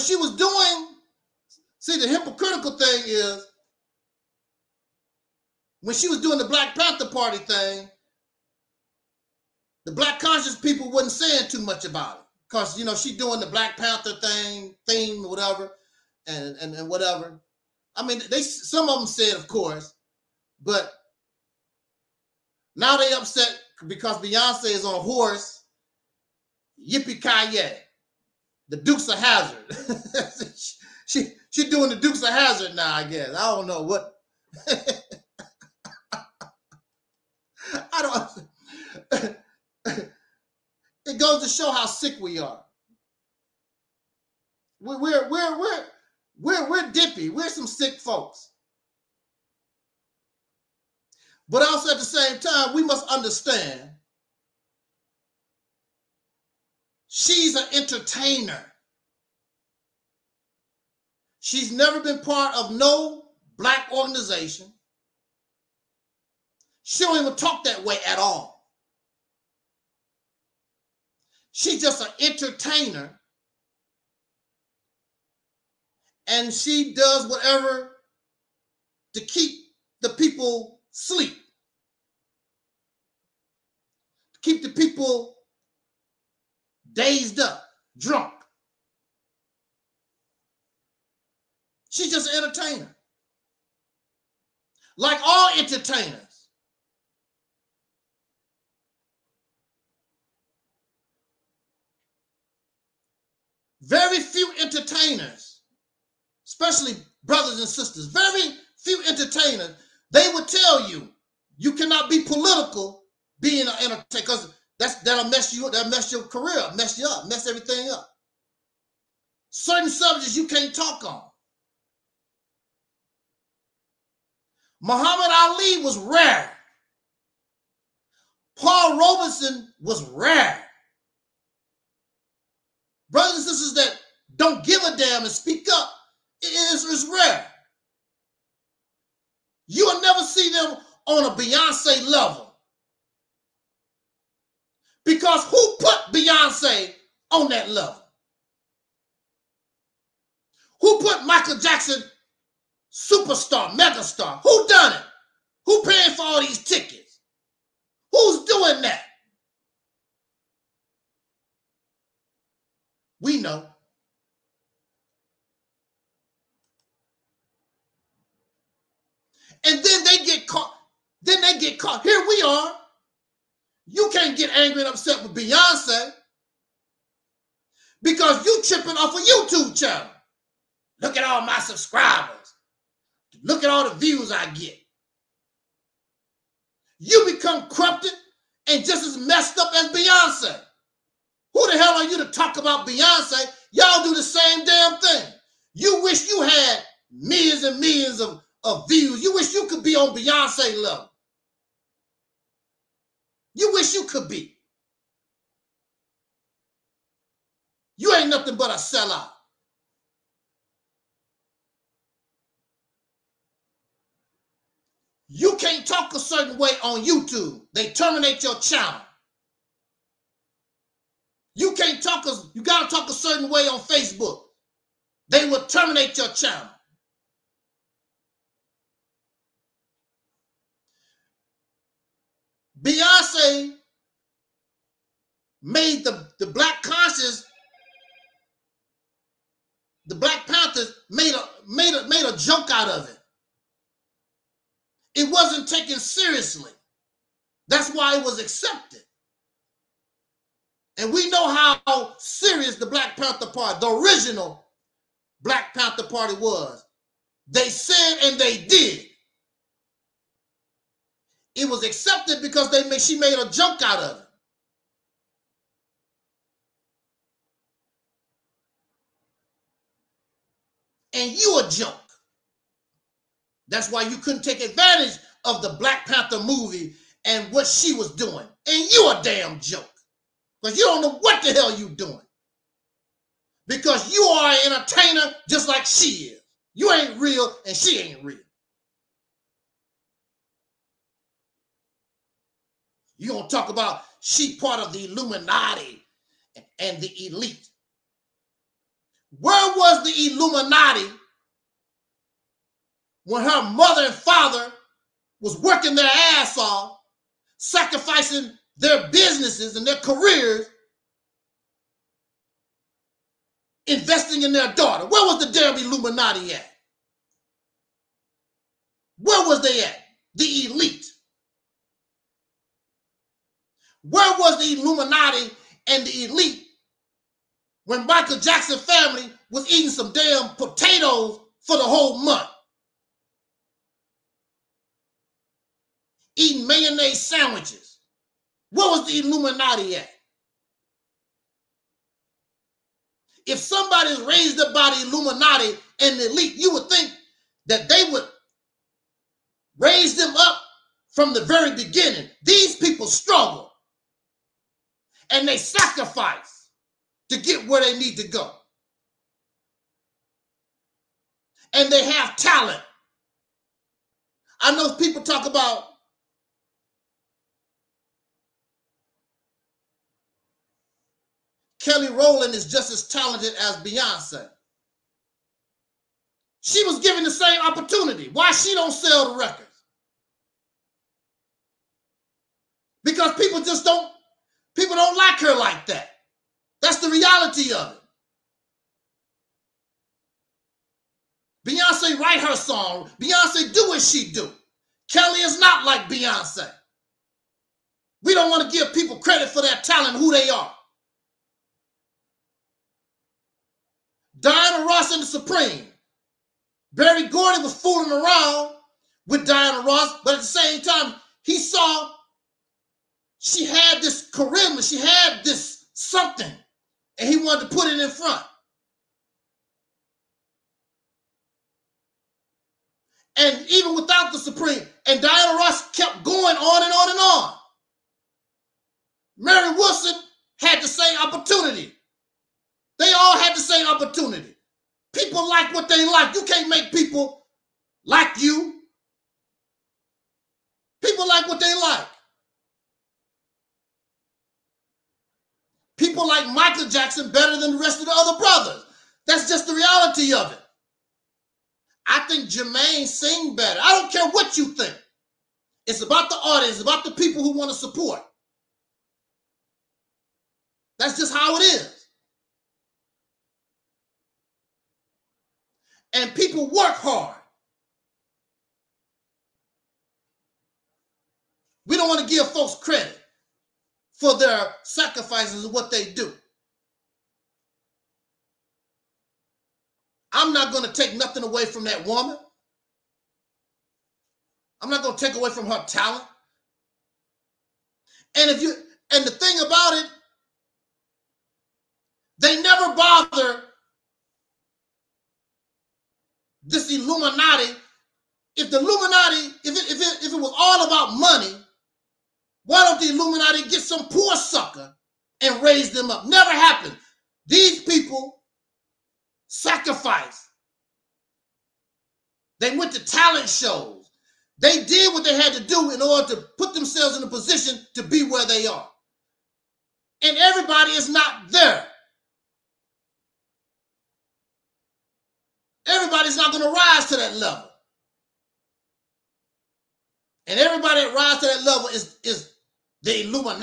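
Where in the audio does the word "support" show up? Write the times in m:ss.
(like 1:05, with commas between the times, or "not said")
7:37.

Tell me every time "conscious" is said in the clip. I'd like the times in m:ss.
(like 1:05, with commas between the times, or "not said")
0:10, 3:56.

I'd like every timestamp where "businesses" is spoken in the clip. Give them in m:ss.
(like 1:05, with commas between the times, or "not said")
5:09.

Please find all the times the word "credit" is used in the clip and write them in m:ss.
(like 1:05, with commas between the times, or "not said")
6:39, 7:52.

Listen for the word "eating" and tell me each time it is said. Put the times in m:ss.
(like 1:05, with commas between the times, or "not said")
5:29, 5:36.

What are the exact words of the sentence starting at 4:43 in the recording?
Because you are an entertainer just like she is.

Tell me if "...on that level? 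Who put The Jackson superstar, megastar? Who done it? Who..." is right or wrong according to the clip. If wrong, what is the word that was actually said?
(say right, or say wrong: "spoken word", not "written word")
wrong: "Michael", not "The".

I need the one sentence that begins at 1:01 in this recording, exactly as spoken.
She's never been part of no black organization.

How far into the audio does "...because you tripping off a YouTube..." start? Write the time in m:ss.
2:58.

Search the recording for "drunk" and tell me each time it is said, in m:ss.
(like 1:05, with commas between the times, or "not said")
1:27.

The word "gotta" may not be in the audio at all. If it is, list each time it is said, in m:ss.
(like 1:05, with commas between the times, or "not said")
3:42.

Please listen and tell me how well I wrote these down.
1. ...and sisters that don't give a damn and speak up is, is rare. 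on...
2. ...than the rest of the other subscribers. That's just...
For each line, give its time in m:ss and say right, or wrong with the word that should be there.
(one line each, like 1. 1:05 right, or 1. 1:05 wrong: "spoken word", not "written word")
1. 2:13 right
2. 7:27 wrong: "brothers", not "subscribers".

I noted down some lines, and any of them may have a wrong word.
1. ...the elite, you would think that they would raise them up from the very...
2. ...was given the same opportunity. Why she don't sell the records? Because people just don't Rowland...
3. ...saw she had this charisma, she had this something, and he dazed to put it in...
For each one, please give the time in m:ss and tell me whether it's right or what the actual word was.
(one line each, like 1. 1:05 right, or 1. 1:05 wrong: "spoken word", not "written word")
1. 5:46 right
2. 6:16 wrong: "People", not "Rowland"
3. 6:51 wrong: "wanted", not "dazed".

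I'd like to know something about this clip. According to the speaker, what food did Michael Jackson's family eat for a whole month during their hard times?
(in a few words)
potatoes.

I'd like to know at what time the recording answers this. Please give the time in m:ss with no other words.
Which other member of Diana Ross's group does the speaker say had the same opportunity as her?
7:09.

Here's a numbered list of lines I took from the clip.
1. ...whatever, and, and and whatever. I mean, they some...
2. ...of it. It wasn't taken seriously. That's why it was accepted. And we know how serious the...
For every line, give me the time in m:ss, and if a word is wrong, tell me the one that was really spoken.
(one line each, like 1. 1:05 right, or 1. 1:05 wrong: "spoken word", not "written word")
1. 0:15 right
2. 4:02 right.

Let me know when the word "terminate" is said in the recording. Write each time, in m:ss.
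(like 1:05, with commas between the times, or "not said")
3:37, 3:45.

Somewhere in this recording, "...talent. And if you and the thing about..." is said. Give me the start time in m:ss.
8:05.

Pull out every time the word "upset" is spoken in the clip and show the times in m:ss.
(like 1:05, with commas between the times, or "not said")
0:23, 2:54.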